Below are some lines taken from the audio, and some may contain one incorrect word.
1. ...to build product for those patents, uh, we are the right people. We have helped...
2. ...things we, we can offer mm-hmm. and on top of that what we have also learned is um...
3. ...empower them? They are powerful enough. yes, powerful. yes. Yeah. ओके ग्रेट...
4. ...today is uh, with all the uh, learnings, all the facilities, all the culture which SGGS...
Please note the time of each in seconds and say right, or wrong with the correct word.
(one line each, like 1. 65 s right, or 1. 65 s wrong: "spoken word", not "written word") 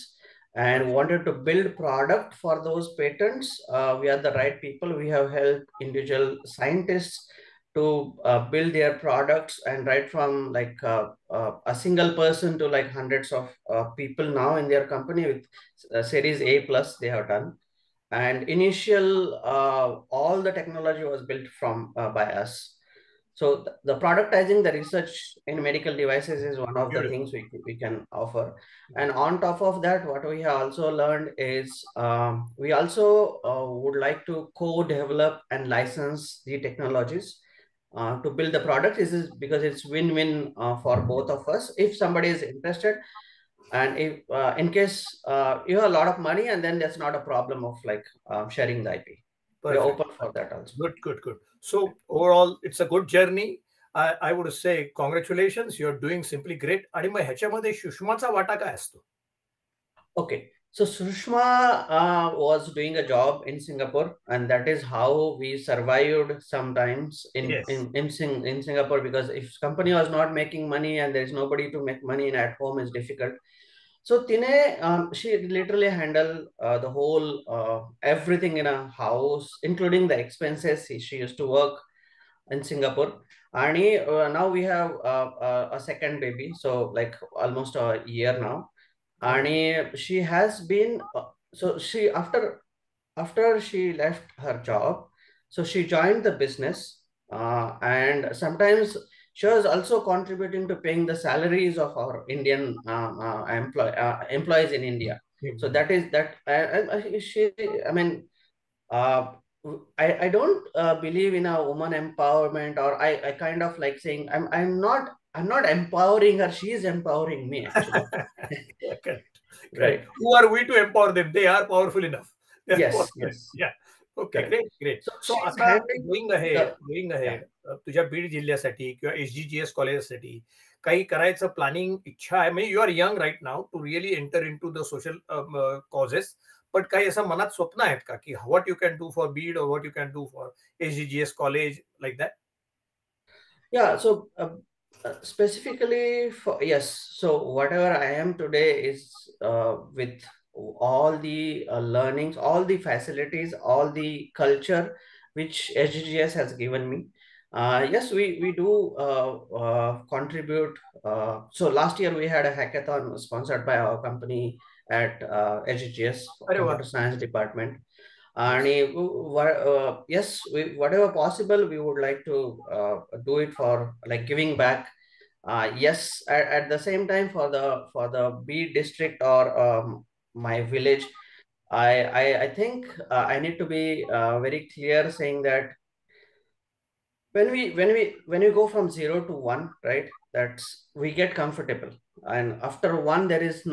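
1. 1 s right
2. 27 s right
3. 120 s right
4. 148 s right.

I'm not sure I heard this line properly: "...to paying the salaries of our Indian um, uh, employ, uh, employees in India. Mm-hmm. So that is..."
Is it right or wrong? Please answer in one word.
right.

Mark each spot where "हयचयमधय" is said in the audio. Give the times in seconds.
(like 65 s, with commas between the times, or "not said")
57 s.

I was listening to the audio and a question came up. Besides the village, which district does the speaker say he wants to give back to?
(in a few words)
Beed.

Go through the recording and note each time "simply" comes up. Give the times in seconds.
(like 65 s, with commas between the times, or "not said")
56 s.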